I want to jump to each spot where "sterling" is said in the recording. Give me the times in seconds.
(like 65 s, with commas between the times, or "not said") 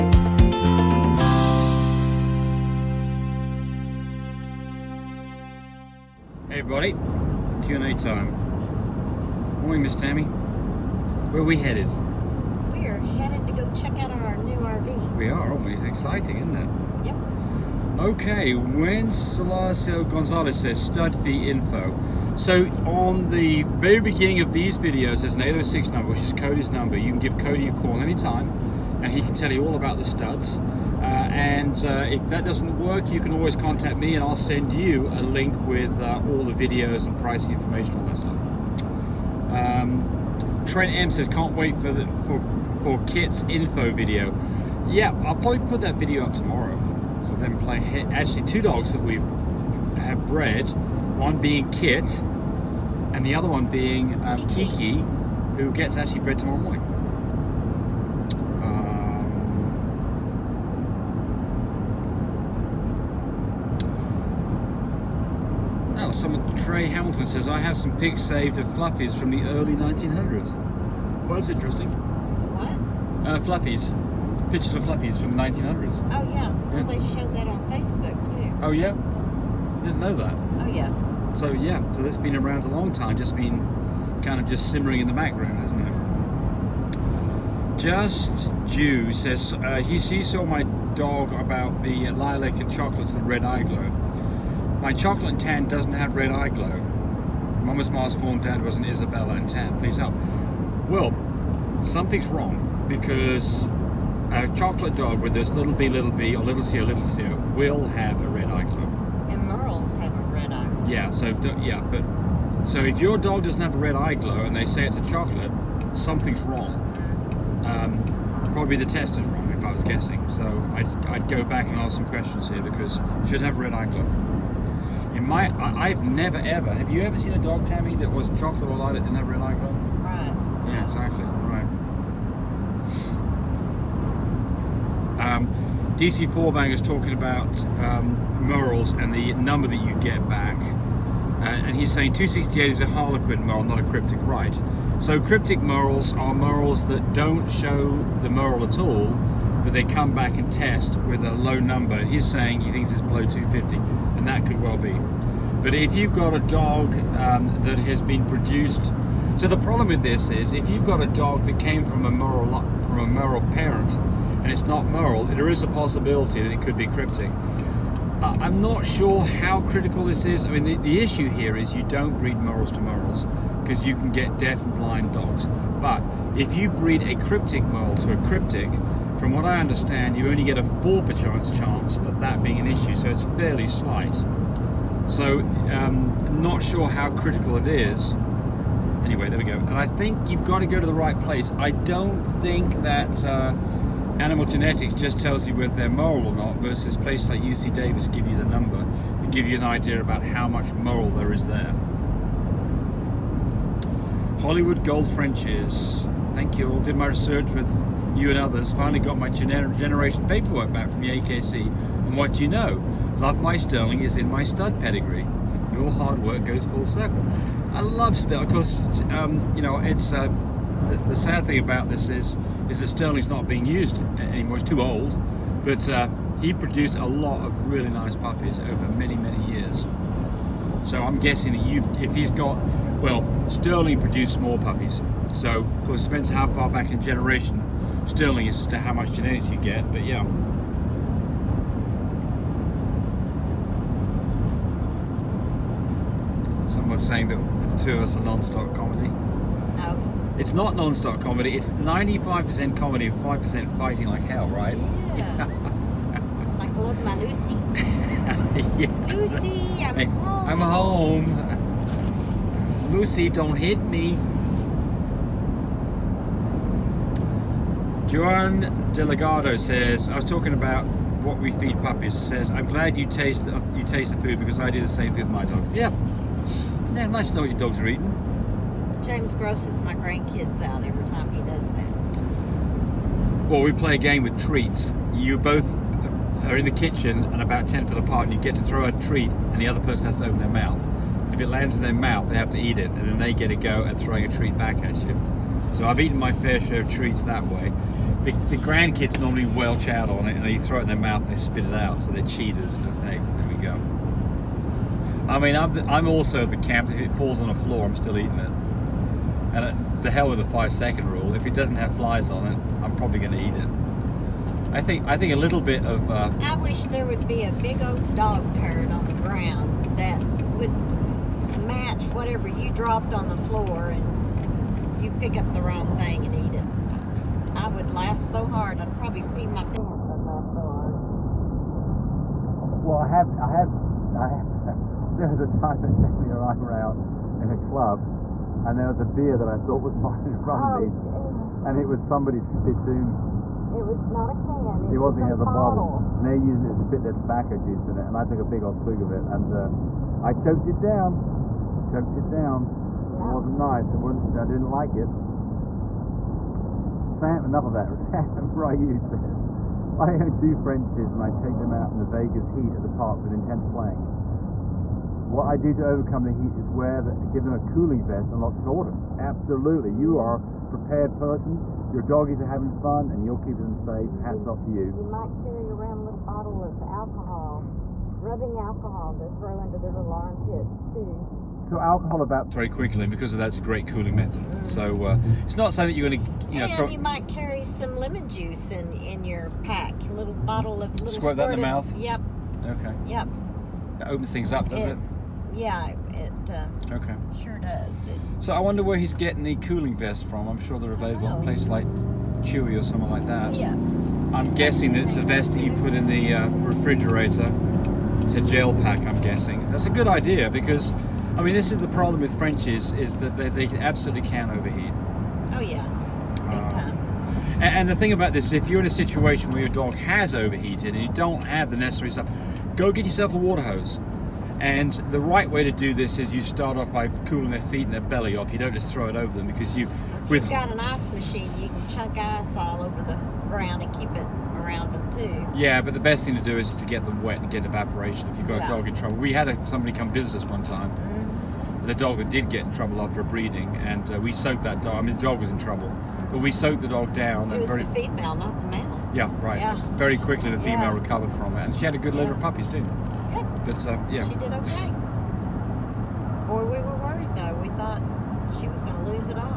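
213 s, 218 s, 222 s, 233 s, 238 s.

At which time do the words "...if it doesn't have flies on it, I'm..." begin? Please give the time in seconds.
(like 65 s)
311 s.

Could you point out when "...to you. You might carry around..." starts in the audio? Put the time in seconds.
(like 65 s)
374 s.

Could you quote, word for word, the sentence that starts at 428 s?
You don't just throw it over them because you.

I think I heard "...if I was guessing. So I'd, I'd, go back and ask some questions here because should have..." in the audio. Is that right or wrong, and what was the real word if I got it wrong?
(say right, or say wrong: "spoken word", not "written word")
right.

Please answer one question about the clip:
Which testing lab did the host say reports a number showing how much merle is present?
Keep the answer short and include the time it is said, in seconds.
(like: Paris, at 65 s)
UC Davis, at 197 s.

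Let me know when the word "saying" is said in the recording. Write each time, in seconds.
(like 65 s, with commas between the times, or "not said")
141 s, 152 s, 247 s, 385 s.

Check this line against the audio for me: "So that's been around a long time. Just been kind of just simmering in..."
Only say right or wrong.
right.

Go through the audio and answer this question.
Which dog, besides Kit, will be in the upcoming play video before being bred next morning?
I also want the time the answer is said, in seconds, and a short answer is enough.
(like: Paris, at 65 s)
Kiki, at 54 s.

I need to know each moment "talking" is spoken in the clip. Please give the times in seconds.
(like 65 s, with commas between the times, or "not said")
136 s, 270 s.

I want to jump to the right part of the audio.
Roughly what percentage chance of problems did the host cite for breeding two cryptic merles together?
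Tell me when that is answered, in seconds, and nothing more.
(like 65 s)
180 s.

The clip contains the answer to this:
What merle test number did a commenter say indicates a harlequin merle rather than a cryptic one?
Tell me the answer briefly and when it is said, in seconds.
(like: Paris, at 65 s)
268, at 142 s.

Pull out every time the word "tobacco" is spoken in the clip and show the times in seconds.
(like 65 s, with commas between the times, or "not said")
347 s.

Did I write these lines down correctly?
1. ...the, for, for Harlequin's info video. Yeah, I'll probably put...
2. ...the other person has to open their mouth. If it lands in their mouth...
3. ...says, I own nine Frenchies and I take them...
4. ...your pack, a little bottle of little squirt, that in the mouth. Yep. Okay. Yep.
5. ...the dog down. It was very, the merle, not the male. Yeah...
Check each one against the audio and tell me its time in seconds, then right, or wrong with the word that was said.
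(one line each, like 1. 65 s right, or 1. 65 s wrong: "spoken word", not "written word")
1. 41 s wrong: "Kit", not "Harlequin"
2. 289 s right
3. 358 s wrong: "two", not "nine"
4. 389 s right
5. 446 s wrong: "female", not "merle".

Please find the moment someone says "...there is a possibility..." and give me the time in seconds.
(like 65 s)
165 s.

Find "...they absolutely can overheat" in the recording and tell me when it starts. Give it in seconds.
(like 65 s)
413 s.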